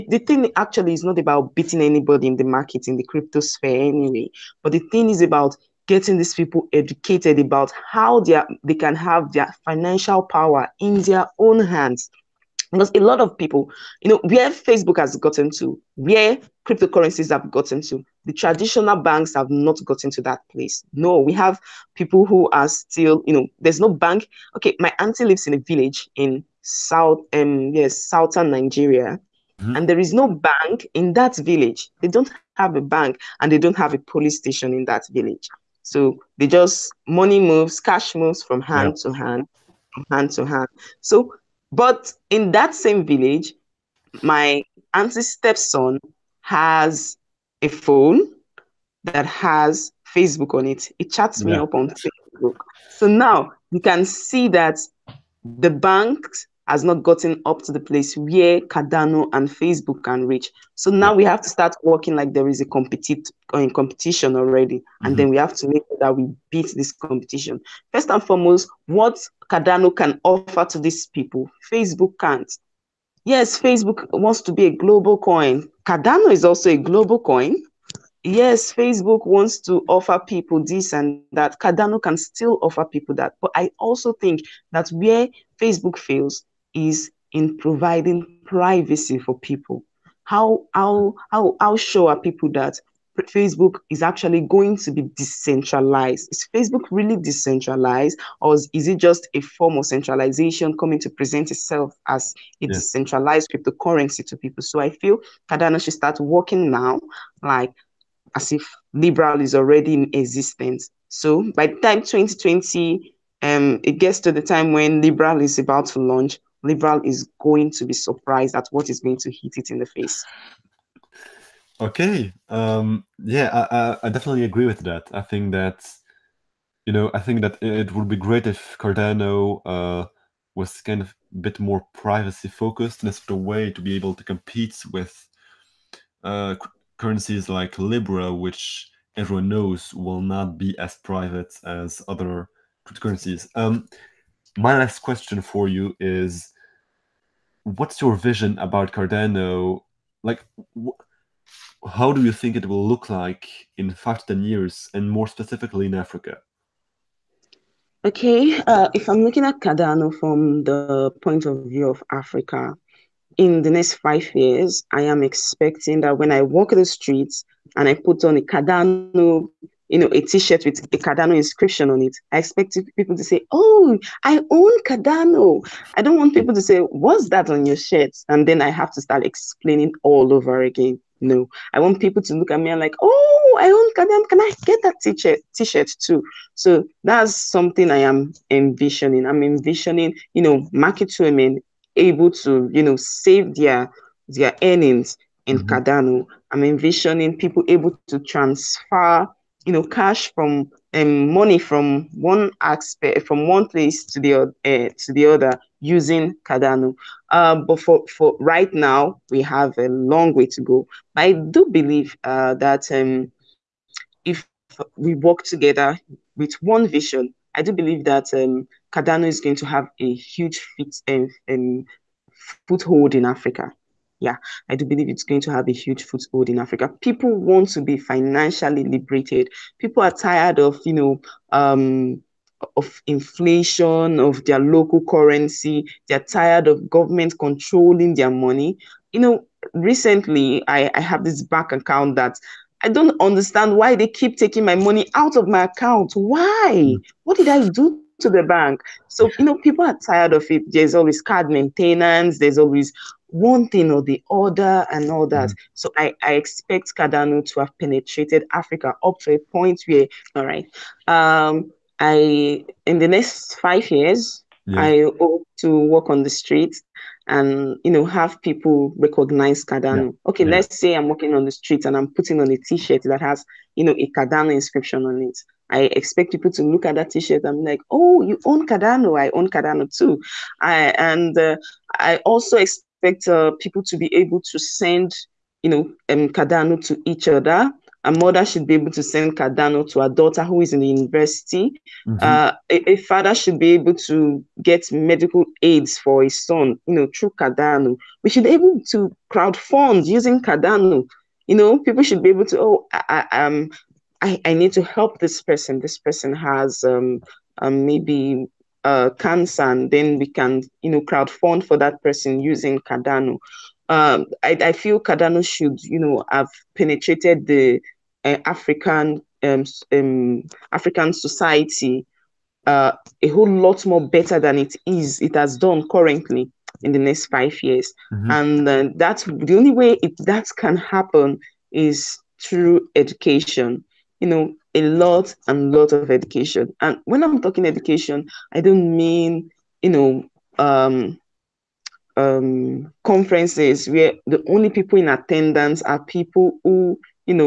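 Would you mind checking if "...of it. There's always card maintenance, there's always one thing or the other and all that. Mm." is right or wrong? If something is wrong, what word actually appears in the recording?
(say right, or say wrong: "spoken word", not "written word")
right.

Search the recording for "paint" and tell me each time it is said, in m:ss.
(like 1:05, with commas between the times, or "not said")
not said.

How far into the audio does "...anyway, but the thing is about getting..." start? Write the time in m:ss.
0:03.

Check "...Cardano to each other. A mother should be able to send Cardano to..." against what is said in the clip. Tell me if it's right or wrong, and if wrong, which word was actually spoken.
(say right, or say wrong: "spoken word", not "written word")
right.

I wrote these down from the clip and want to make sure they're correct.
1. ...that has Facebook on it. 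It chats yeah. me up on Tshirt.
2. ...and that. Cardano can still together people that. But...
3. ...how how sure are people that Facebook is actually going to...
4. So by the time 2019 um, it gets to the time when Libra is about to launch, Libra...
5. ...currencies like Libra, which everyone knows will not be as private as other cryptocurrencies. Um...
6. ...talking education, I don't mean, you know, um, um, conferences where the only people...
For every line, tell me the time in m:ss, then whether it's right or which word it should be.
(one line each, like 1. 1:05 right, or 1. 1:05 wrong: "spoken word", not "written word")
1. 0:49 wrong: "Facebook", not "Tshirt"
2. 1:20 wrong: "offer", not "together"
3. 1:31 right
4. 1:51 wrong: "2020", not "2019"
5. 2:16 right
6. 5:37 right.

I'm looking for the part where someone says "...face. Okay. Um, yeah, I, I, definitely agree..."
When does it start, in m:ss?
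1:59.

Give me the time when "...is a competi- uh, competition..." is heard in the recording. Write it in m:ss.
1:02.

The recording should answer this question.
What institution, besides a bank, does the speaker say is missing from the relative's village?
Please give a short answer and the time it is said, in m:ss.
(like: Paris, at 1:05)
police station, at 0:33.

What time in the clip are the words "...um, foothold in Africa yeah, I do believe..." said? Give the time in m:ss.
3:41.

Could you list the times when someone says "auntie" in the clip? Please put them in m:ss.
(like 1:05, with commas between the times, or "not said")
0:24, 0:44.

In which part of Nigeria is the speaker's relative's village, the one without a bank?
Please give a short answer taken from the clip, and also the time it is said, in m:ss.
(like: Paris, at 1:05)
southern Nigeria, at 0:28.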